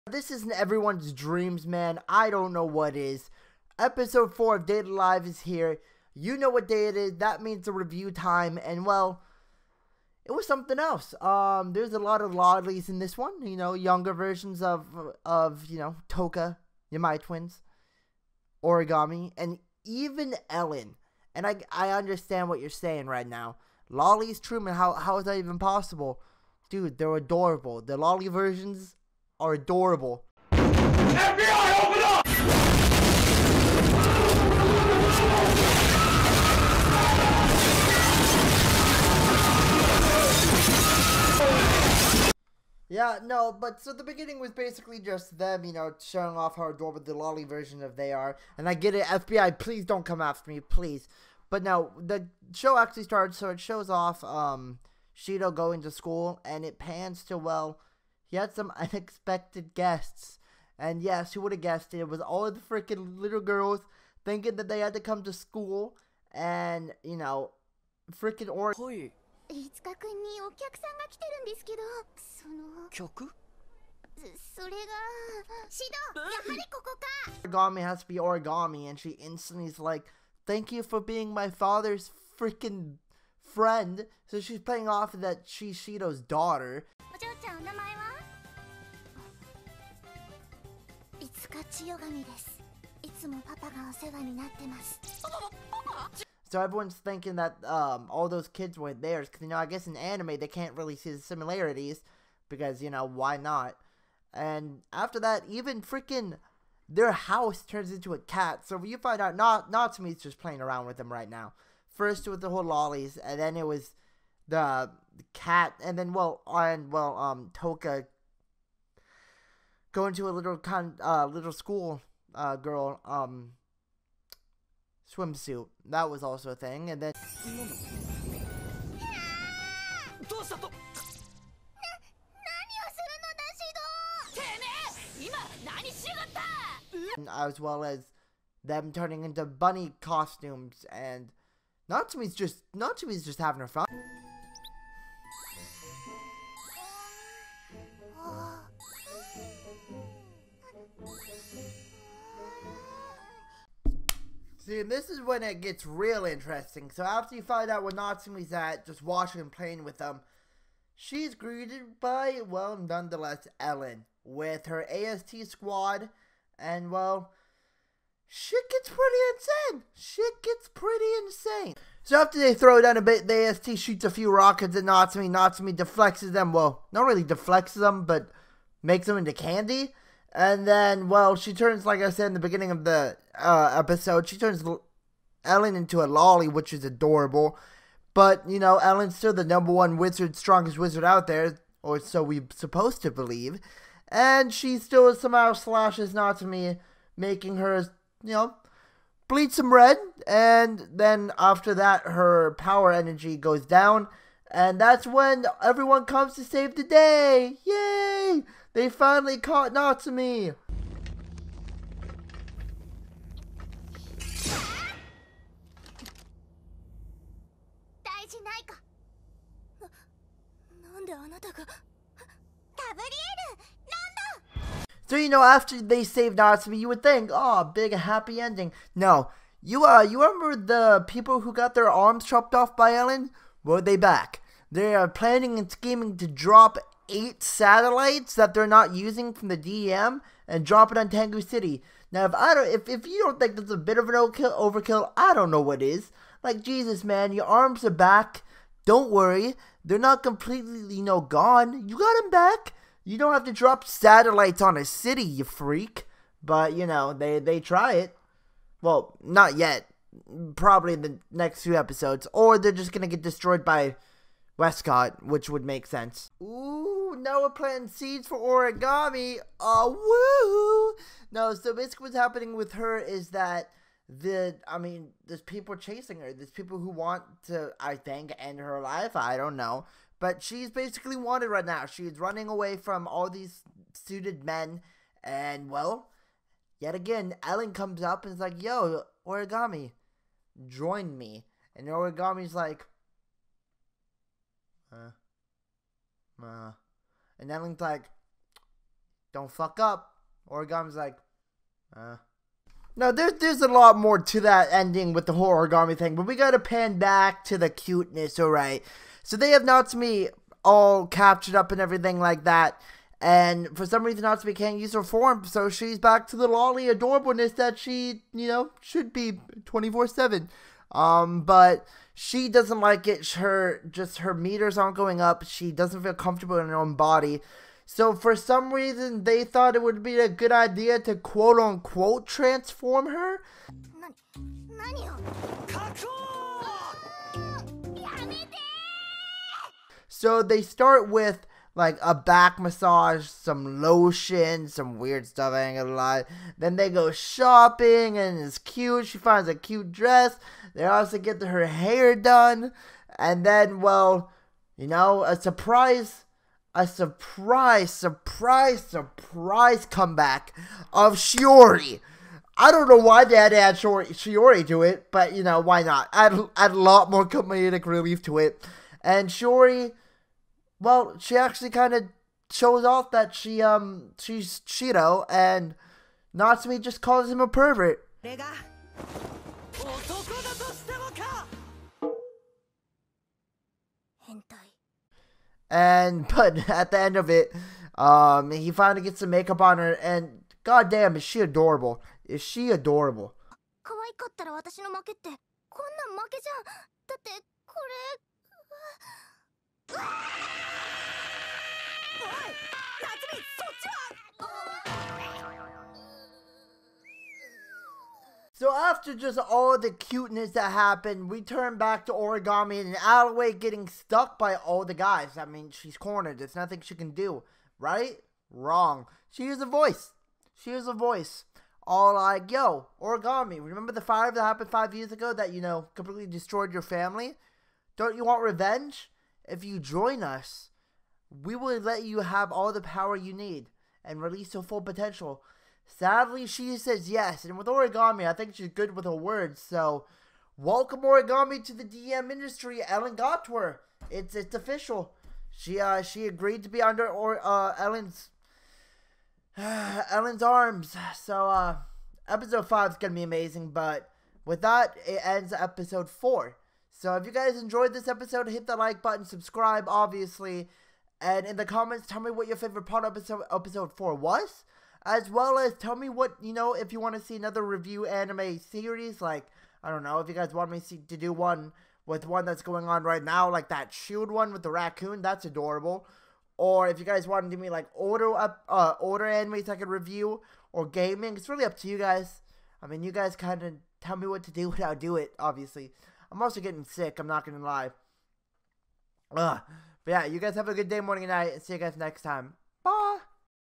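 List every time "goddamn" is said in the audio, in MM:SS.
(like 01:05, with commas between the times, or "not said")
06:30.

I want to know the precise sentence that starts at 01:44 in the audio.
And after that, even freaking their house turns into a cat.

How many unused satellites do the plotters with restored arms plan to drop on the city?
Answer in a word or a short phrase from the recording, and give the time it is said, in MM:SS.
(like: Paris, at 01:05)
8, at 03:57.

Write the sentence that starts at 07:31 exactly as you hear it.
So uh episode five is gonna be amazing.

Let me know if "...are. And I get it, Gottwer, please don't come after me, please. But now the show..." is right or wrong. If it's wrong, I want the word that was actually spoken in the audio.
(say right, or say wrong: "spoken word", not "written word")
wrong: "FBI", not "Gottwer".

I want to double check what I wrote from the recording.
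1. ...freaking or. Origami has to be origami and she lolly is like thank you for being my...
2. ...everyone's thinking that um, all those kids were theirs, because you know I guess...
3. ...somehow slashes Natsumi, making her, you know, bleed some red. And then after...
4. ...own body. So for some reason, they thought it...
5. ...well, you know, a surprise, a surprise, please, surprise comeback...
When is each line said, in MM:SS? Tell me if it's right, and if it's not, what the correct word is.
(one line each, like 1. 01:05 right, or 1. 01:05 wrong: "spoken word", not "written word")
1. 01:08 wrong: "instantly", not "lolly"
2. 01:36 right
3. 03:15 right
4. 05:26 right
5. 05:53 wrong: "surprise", not "please".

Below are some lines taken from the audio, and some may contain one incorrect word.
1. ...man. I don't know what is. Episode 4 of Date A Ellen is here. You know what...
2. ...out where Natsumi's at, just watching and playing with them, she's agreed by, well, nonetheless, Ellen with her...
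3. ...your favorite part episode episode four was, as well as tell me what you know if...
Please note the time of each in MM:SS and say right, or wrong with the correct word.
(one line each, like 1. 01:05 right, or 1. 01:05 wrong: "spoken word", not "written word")
1. 00:01 wrong: "Live", not "Ellen"
2. 02:37 wrong: "greeted", not "agreed"
3. 07:42 right.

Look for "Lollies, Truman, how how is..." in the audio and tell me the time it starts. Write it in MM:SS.
00:23.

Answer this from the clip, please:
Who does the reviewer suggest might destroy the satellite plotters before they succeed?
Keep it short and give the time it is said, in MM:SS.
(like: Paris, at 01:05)
Westcott, at 04:24.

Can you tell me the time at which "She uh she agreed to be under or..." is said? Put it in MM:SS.
07:25.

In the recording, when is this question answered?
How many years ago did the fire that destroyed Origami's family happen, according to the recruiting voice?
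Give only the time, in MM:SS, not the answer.
07:04.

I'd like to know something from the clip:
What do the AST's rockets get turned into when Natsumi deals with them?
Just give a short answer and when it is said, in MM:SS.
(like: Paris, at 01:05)
Candy, at 02:59.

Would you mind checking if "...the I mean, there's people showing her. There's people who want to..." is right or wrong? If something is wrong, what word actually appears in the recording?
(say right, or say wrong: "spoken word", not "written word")
wrong: "chasing", not "showing".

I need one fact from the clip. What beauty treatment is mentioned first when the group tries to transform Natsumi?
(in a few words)
Back massage.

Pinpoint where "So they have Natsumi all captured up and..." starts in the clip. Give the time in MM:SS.
05:09.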